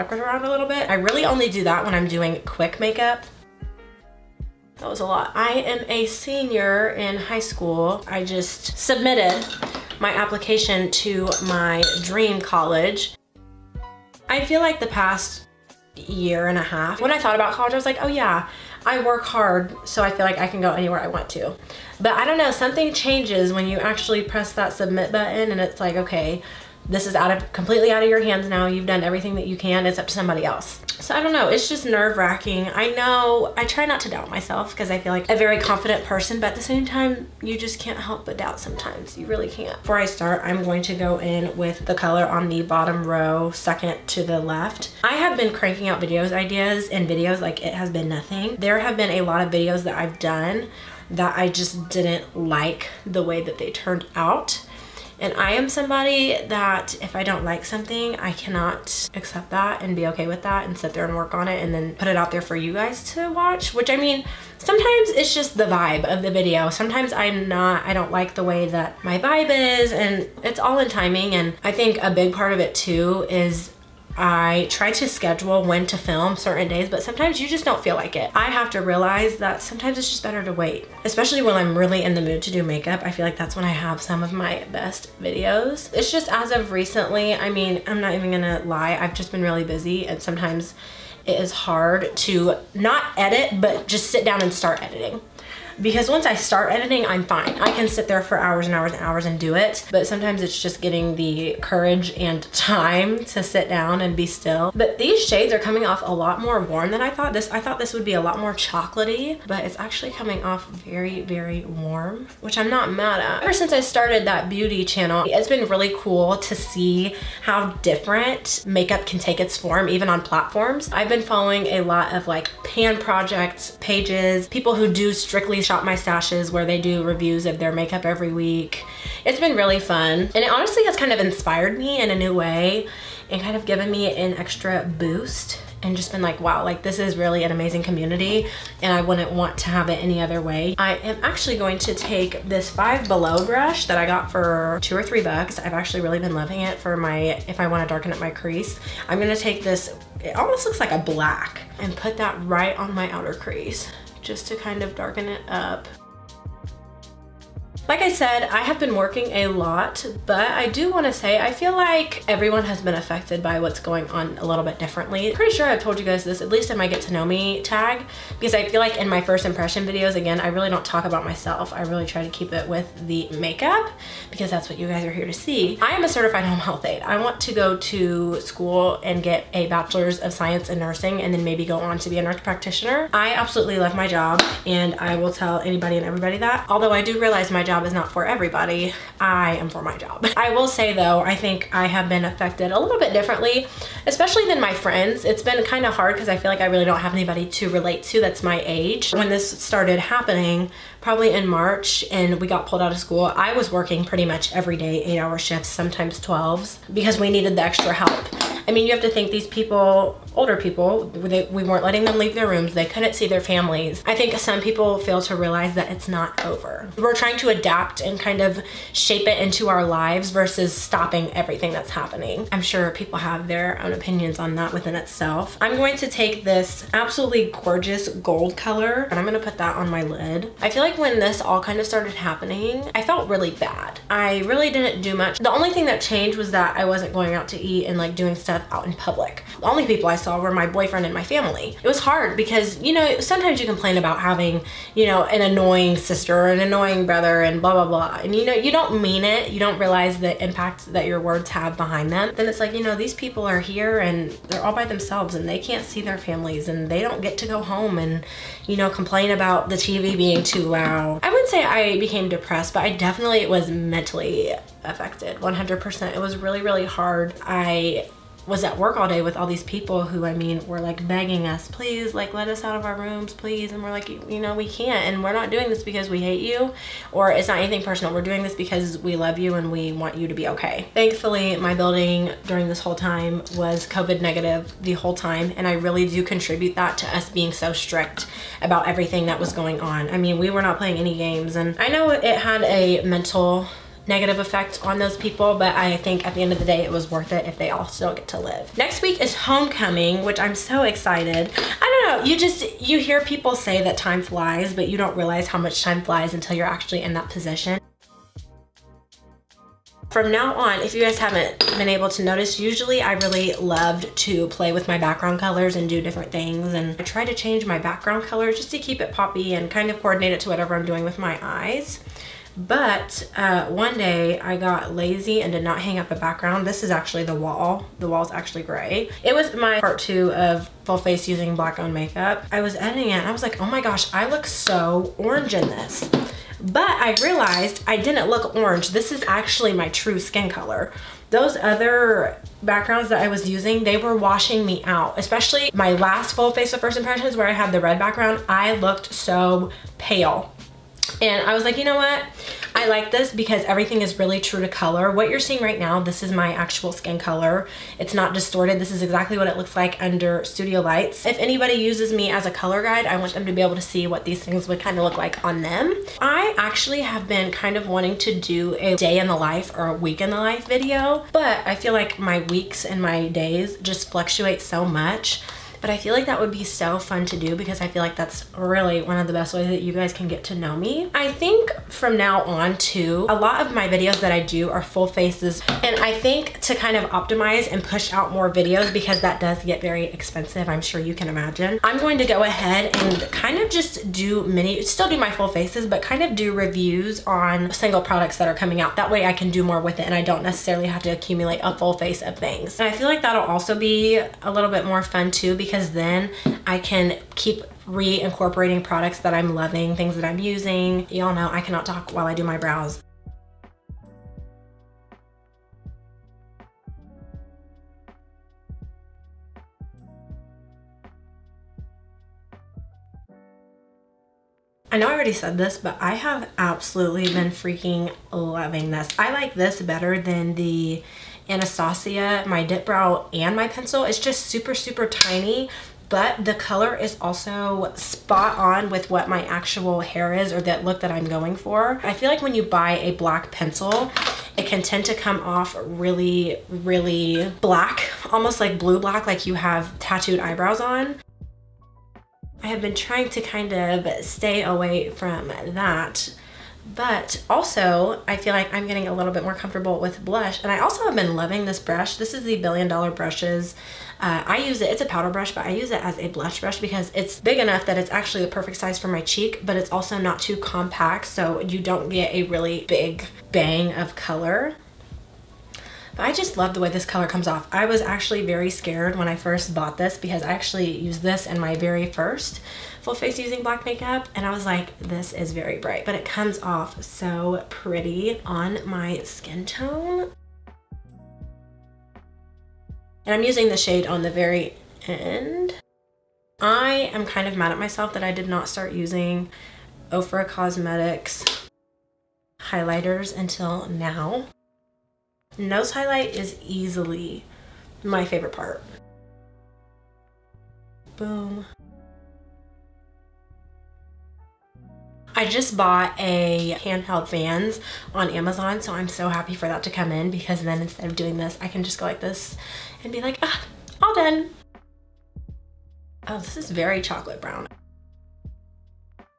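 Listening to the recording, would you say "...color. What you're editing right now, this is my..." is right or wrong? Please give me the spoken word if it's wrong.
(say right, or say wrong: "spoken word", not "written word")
wrong: "seeing", not "editing".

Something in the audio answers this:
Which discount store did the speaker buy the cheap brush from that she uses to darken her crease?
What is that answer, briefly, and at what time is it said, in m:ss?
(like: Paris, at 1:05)
Five Below, at 2:22.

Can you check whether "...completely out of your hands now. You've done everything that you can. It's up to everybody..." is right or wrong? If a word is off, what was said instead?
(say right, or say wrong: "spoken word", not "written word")
wrong: "somebody", not "everybody".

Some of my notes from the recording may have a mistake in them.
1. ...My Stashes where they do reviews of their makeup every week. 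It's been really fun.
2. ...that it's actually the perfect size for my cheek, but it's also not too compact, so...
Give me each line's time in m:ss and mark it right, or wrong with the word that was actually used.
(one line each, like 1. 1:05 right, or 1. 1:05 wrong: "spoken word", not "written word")
1. 2:05 right
2. 7:47 right.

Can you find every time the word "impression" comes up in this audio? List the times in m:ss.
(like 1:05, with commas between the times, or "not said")
2:49, 5:46.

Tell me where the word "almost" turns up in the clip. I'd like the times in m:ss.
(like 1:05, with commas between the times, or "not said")
2:30, 7:28.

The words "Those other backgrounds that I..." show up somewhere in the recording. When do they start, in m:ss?
5:41.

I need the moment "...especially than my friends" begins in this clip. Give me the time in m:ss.
3:14.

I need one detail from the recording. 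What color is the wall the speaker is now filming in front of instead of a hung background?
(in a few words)
Gray.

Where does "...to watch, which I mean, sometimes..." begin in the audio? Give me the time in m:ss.
1:03.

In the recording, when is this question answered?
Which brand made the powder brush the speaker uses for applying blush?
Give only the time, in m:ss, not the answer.
7:42.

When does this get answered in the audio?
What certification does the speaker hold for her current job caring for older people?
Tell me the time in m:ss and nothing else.
2:56.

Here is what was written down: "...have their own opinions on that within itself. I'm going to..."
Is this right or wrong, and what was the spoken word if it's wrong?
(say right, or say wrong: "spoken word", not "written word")
right.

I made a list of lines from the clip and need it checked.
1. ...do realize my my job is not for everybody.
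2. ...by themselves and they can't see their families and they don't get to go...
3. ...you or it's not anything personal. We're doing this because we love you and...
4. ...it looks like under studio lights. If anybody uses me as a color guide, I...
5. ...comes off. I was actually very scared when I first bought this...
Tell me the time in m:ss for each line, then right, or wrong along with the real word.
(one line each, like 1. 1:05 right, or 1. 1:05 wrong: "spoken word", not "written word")
1. 3:07 right
2. 4:14 right
3. 4:36 right
4. 5:59 right
5. 7:57 right.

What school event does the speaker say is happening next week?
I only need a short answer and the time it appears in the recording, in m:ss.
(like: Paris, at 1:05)
Homecoming, at 4:59.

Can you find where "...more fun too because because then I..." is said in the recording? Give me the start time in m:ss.
6:44.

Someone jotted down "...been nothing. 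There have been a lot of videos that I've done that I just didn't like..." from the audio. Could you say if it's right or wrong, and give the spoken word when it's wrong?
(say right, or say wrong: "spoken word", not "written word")
right.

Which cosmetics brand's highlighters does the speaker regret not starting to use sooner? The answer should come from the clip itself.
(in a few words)
Ofra Cosmetics.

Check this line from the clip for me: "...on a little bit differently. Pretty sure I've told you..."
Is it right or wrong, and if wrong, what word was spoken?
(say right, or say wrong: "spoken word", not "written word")
right.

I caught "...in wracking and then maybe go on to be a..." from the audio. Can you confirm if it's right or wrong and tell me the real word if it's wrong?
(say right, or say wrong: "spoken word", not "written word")
wrong: "nursing", not "wracking".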